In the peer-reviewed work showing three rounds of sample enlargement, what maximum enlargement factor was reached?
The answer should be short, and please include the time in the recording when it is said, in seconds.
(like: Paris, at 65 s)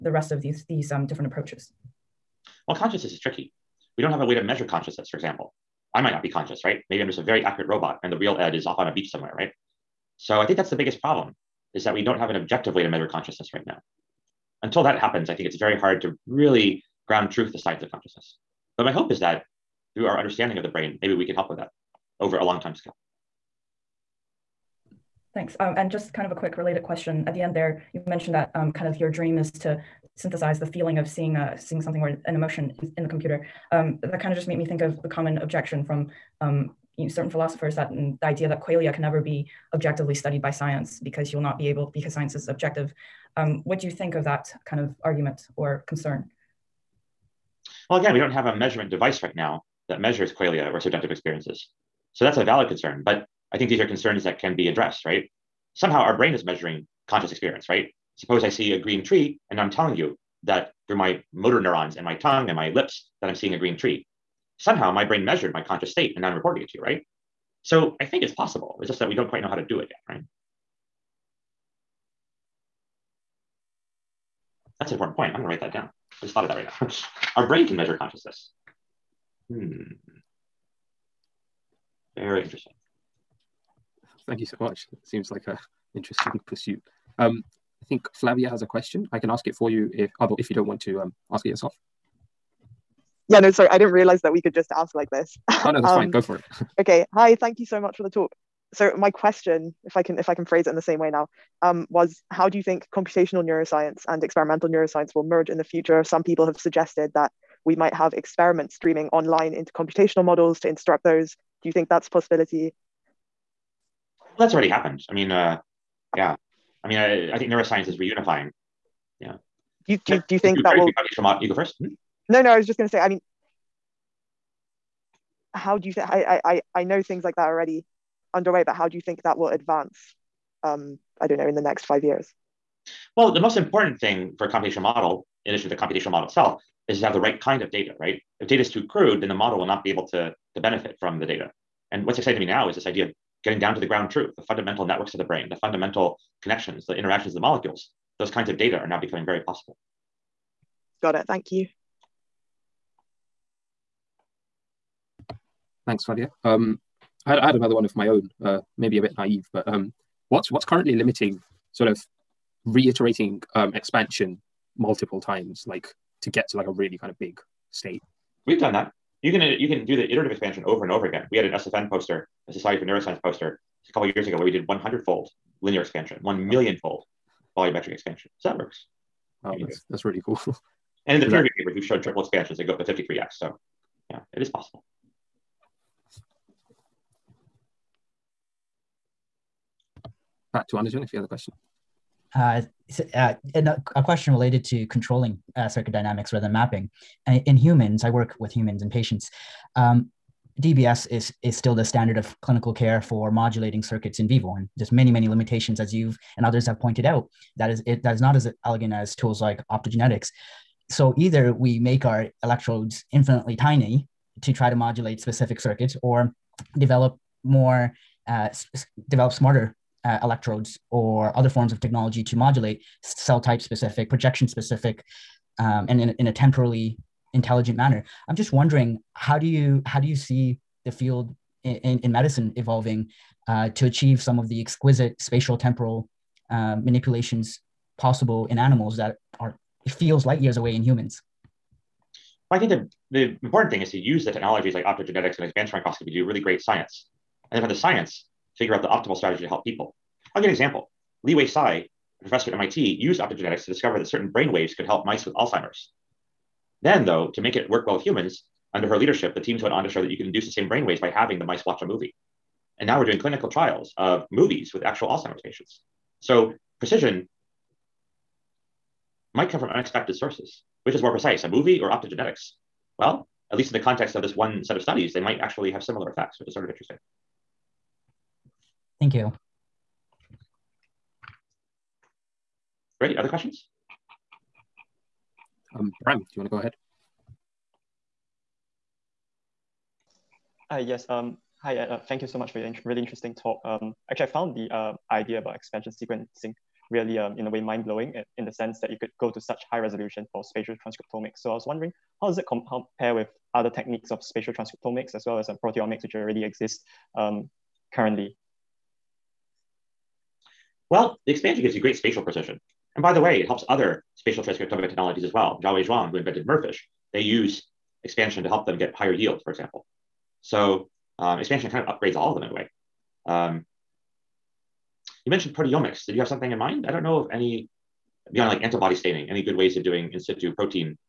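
53x, at 182 s.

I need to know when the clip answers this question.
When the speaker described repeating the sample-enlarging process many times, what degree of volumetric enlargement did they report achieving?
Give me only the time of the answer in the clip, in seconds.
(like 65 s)
176 s.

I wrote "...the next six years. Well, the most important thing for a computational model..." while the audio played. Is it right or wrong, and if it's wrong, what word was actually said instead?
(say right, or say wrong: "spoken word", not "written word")
wrong: "five", not "six".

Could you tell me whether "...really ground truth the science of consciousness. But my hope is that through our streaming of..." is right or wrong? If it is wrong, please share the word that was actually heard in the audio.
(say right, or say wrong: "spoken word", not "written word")
wrong: "understanding", not "streaming".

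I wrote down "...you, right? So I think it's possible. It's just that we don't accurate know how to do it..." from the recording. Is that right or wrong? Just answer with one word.
wrong.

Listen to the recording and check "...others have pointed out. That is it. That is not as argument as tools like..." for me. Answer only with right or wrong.
wrong.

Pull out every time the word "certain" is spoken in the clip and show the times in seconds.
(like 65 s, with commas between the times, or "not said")
37 s, 254 s.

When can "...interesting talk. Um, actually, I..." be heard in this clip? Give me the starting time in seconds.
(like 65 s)
292 s.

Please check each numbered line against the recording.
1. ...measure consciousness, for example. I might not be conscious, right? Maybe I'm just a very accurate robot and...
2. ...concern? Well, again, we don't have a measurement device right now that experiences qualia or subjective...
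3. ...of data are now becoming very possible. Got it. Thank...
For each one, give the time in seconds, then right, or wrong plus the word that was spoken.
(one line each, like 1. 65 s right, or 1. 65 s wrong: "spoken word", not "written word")
1. 4 s right
2. 45 s wrong: "measures", not "experiences"
3. 148 s right.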